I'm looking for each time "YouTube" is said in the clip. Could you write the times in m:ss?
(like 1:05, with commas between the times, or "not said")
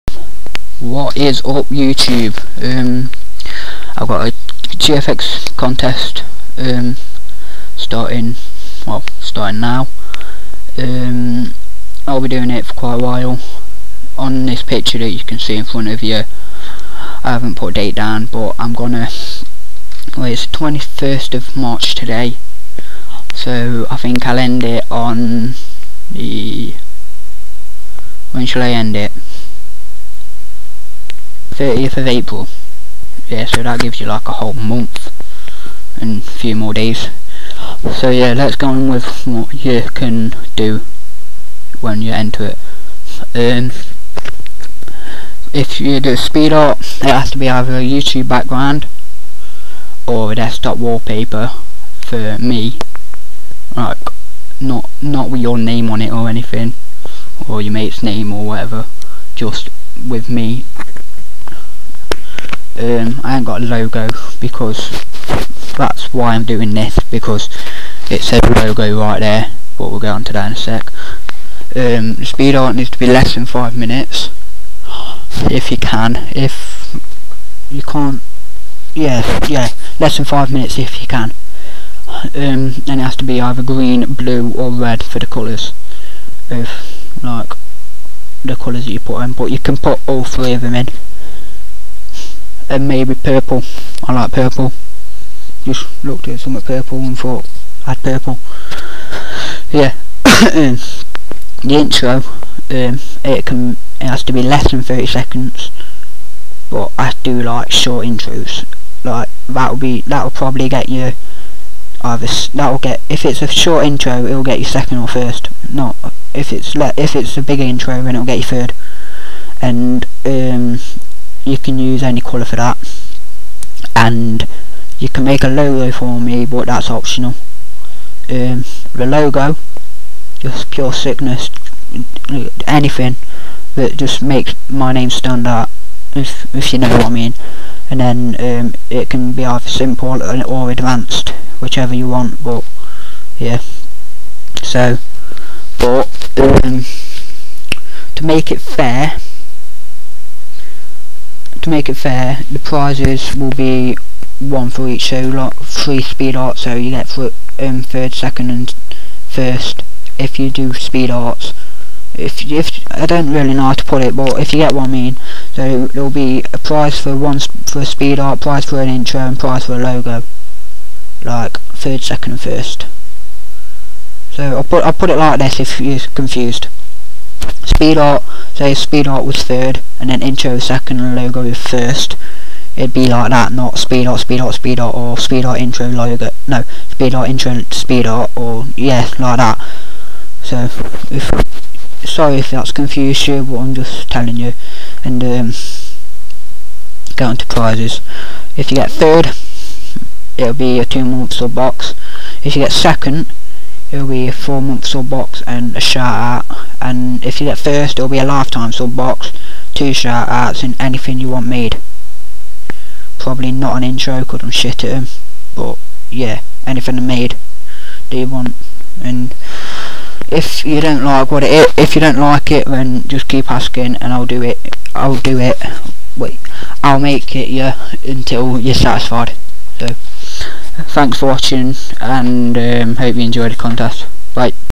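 0:01, 0:47.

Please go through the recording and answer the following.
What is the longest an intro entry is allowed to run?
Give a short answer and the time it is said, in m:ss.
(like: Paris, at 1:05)
30 seconds, at 1:44.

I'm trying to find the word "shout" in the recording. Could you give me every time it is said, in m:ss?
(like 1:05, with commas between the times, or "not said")
3:25, 3:29.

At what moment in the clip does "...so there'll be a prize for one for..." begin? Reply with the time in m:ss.
2:45.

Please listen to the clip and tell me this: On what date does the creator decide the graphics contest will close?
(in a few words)
30th of April.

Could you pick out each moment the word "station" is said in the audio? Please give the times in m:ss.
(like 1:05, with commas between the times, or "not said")
not said.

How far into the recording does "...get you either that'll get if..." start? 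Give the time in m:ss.
1:50.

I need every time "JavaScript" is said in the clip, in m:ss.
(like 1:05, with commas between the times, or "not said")
not said.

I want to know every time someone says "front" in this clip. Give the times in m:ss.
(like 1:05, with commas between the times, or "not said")
0:15.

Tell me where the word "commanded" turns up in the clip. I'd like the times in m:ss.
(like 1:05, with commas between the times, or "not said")
not said.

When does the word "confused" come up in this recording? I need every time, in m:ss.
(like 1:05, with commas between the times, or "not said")
2:56, 3:12.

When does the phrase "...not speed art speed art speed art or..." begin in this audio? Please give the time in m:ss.
3:03.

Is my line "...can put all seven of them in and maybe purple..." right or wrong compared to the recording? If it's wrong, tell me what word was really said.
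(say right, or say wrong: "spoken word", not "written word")
wrong: "three", not "seven".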